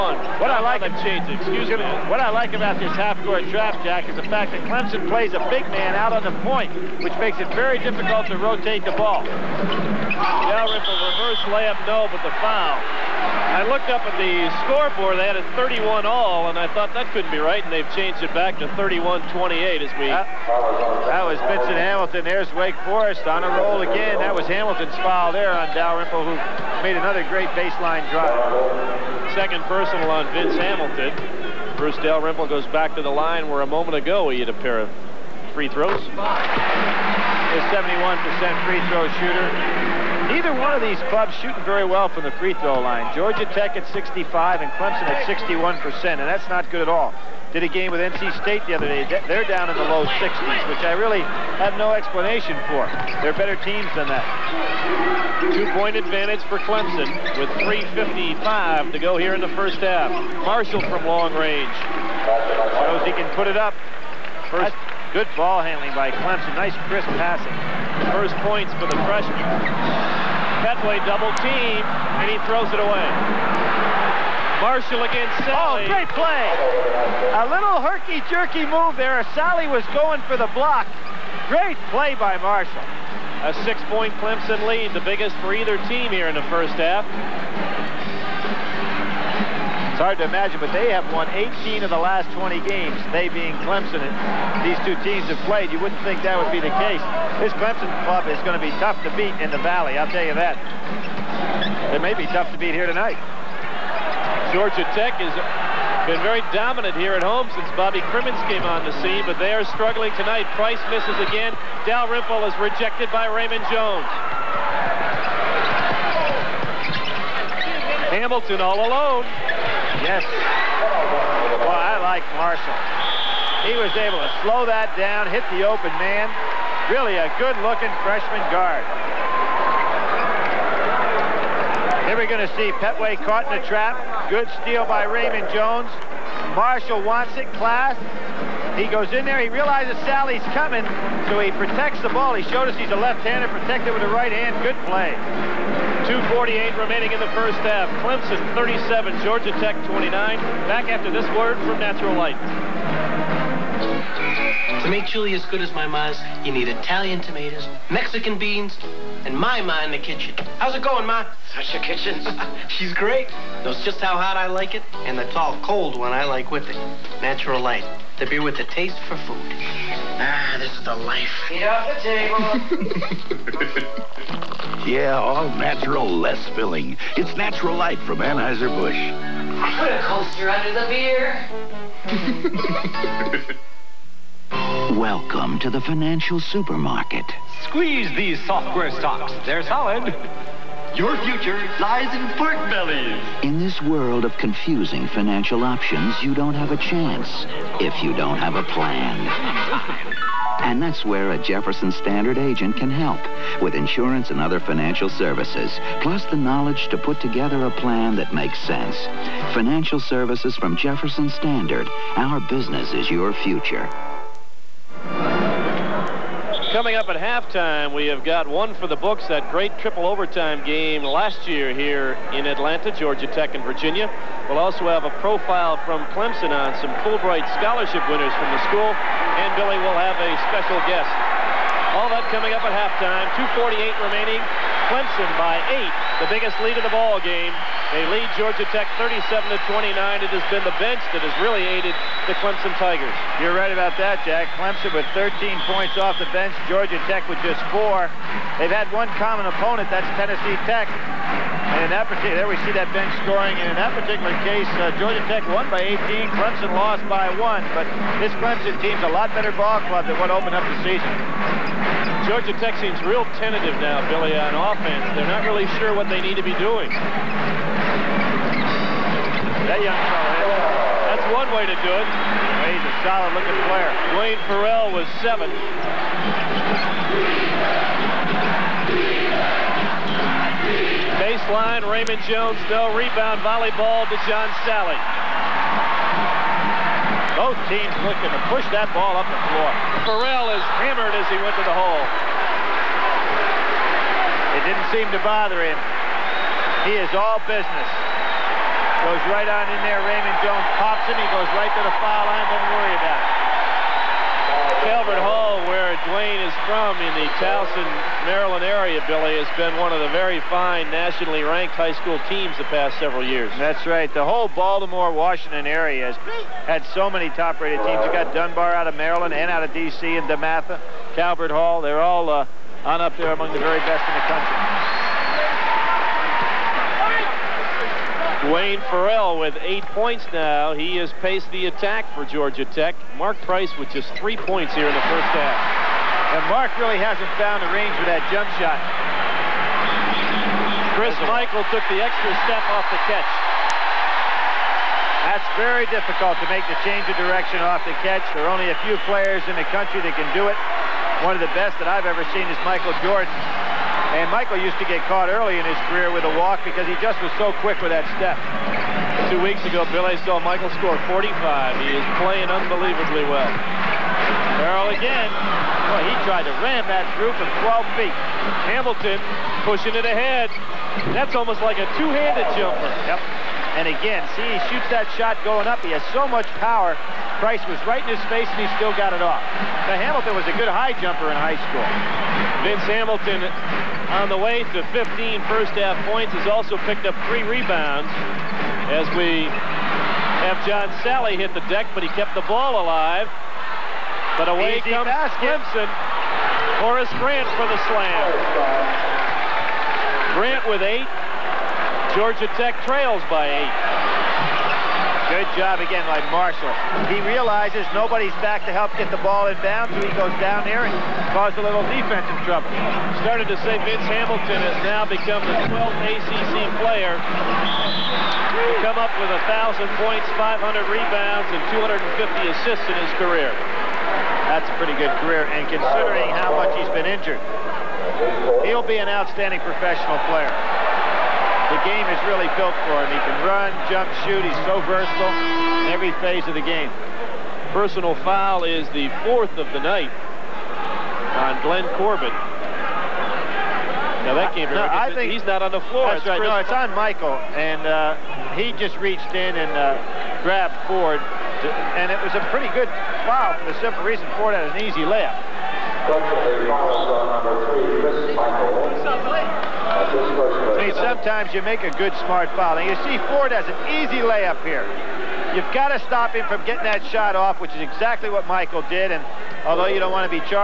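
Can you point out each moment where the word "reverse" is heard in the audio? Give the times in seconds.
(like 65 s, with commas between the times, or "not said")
10 s.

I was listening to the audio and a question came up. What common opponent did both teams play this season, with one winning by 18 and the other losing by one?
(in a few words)
Tennessee Tech.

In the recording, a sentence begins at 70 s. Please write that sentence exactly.
Petway double team, and he throws it away.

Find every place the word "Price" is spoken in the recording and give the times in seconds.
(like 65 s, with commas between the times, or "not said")
110 s, 333 s, 377 s.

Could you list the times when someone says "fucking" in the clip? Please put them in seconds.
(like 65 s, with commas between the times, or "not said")
not said.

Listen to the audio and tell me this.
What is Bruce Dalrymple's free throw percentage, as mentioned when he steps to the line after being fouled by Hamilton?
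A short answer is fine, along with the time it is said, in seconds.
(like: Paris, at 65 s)
71%, at 37 s.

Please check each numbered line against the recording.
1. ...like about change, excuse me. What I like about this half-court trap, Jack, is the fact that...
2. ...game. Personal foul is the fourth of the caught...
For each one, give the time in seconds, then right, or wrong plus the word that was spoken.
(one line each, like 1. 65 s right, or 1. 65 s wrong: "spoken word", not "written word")
1. 0 s right
2. 436 s wrong: "night", not "caught".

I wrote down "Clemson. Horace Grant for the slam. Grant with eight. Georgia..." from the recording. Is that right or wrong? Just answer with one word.
right.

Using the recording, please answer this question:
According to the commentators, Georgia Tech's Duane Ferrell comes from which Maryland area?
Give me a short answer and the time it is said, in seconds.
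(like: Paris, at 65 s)
Towson, at 307 s.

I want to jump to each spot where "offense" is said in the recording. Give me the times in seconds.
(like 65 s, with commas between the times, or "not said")
264 s.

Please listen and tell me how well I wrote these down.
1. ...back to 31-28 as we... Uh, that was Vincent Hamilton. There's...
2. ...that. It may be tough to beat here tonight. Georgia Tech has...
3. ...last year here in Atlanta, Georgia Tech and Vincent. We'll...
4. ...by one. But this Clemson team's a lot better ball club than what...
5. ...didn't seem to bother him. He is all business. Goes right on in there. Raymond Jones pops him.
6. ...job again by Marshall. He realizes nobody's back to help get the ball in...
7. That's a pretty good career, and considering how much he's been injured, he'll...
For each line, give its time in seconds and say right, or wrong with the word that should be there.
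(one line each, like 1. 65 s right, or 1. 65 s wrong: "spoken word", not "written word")
1. 18 s right
2. 100 s right
3. 221 s wrong: "Virginia", not "Vincent"
4. 257 s right
5. 294 s right
6. 405 s right
7. 424 s right.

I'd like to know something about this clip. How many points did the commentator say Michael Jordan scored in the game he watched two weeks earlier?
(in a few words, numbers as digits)
45.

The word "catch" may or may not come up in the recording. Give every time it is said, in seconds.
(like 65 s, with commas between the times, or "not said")
343 s, 348 s.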